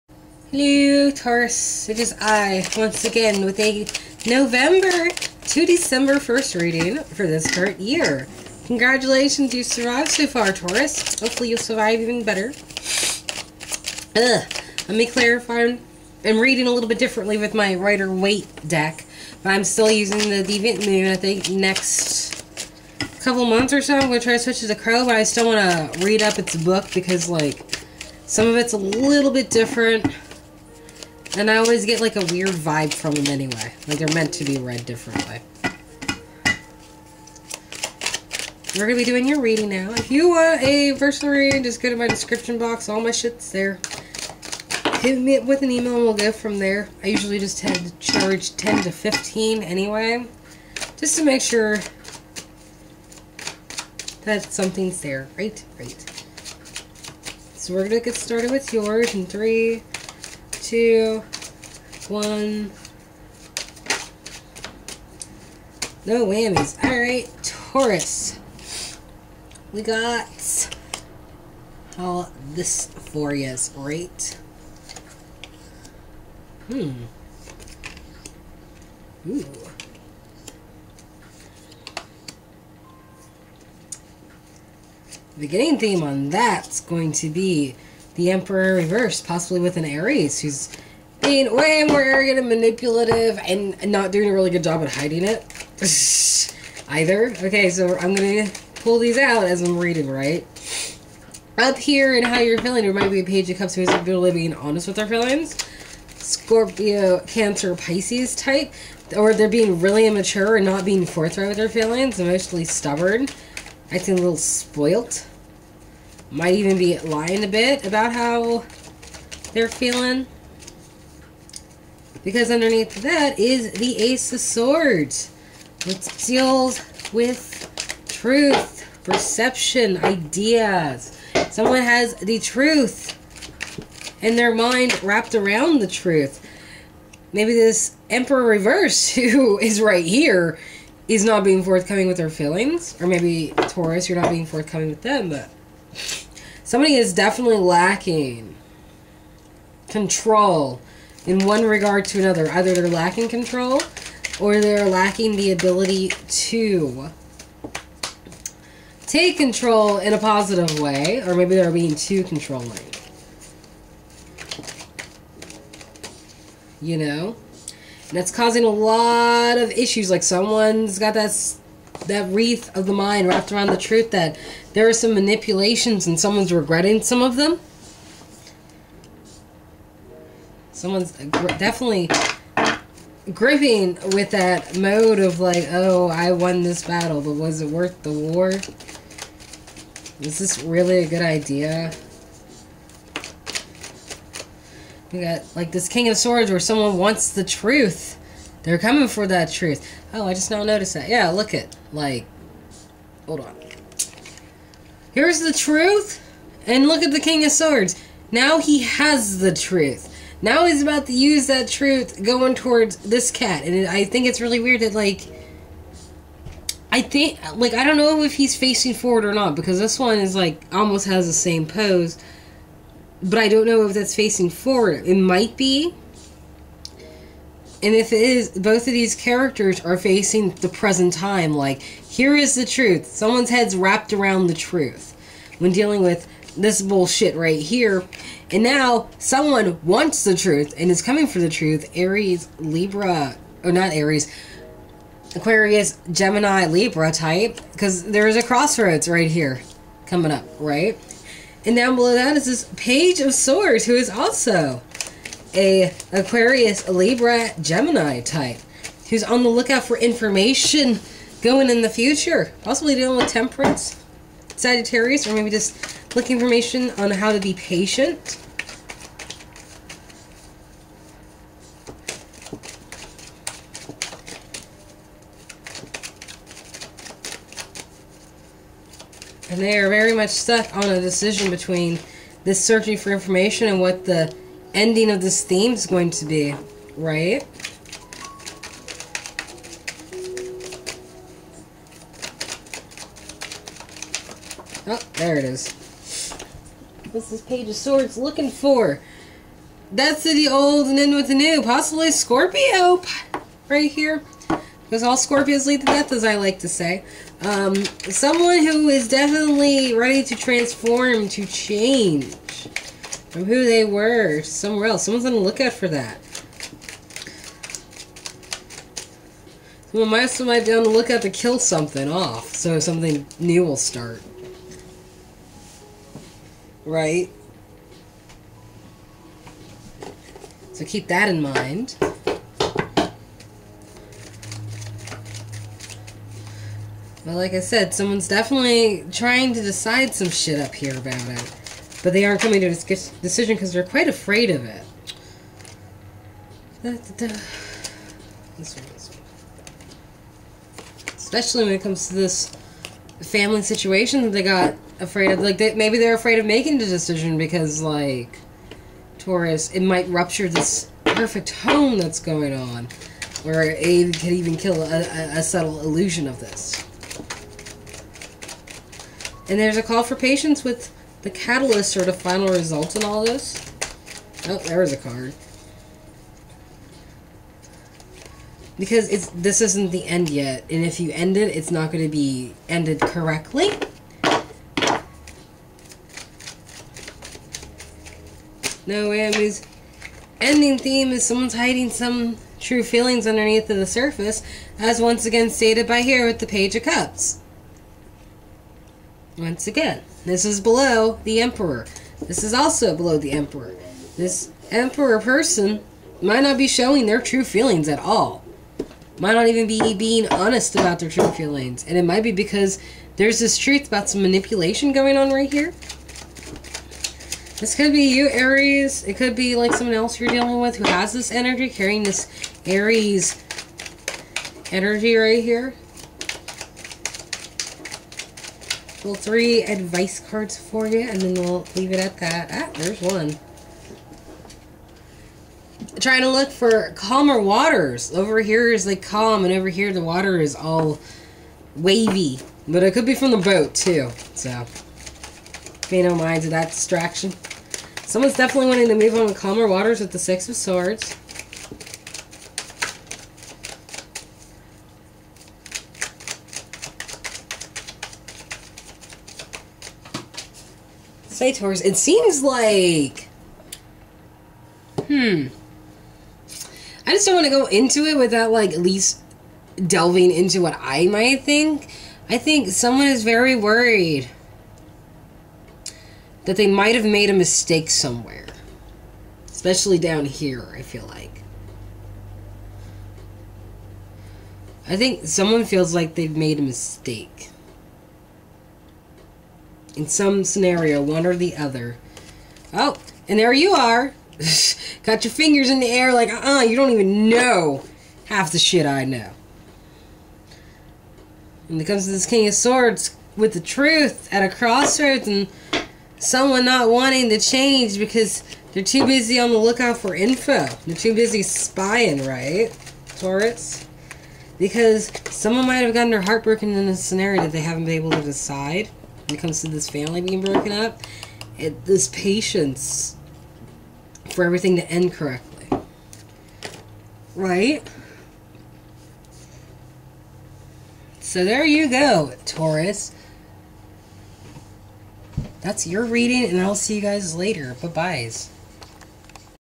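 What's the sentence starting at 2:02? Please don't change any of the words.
Because underneath that is the Ace of Swords, which deals with truth, perception, ideas.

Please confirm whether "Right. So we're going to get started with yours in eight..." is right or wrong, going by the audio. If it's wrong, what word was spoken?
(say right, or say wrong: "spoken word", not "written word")
wrong: "three", not "eight".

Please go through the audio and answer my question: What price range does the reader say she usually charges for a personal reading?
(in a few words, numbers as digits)
10 to 15.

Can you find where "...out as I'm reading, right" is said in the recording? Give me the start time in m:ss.
1:39.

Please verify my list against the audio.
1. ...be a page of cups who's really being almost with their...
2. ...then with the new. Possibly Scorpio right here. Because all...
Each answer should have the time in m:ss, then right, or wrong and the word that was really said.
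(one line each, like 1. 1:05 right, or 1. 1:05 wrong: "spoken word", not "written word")
1. 1:43 wrong: "honest", not "almost"
2. 5:00 right.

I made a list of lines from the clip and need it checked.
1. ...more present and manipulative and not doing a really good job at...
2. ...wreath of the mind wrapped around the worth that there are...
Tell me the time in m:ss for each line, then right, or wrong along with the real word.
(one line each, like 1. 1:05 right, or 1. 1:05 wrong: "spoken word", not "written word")
1. 1:31 wrong: "arrogant", not "present"
2. 2:52 wrong: "truth", not "worth".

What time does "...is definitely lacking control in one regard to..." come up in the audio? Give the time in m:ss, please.
2:26.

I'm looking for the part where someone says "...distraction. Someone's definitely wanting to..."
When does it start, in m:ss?
7:26.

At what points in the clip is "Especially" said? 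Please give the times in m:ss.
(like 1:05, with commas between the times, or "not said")
5:51, 7:59.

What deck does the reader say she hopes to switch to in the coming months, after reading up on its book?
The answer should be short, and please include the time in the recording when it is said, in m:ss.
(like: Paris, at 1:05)
the Crow, at 0:24.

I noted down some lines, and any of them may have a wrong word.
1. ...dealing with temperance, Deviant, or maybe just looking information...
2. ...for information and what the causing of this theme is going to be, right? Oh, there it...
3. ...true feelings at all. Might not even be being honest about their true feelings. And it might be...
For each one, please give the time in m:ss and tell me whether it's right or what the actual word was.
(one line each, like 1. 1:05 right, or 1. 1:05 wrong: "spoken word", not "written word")
1. 4:22 wrong: "Sagittarius", not "Deviant"
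2. 4:42 wrong: "ending", not "causing"
3. 6:47 right.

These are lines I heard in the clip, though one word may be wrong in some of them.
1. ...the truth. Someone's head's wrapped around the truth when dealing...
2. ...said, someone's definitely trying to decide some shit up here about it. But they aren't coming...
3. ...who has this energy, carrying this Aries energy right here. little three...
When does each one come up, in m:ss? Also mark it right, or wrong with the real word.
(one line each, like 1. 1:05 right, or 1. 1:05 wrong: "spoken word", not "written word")
1. 3:52 right
2. 5:37 right
3. 7:00 right.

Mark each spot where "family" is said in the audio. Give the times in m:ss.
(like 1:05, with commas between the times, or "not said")
5:53, 8:39.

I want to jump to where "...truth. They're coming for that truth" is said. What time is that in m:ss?
3:17.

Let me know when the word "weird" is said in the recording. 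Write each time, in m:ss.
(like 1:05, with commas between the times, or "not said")
0:32, 3:34.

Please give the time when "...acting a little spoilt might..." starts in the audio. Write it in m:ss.
1:53.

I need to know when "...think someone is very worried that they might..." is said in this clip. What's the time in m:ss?
7:52.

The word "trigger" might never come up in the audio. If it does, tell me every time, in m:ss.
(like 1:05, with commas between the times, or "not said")
not said.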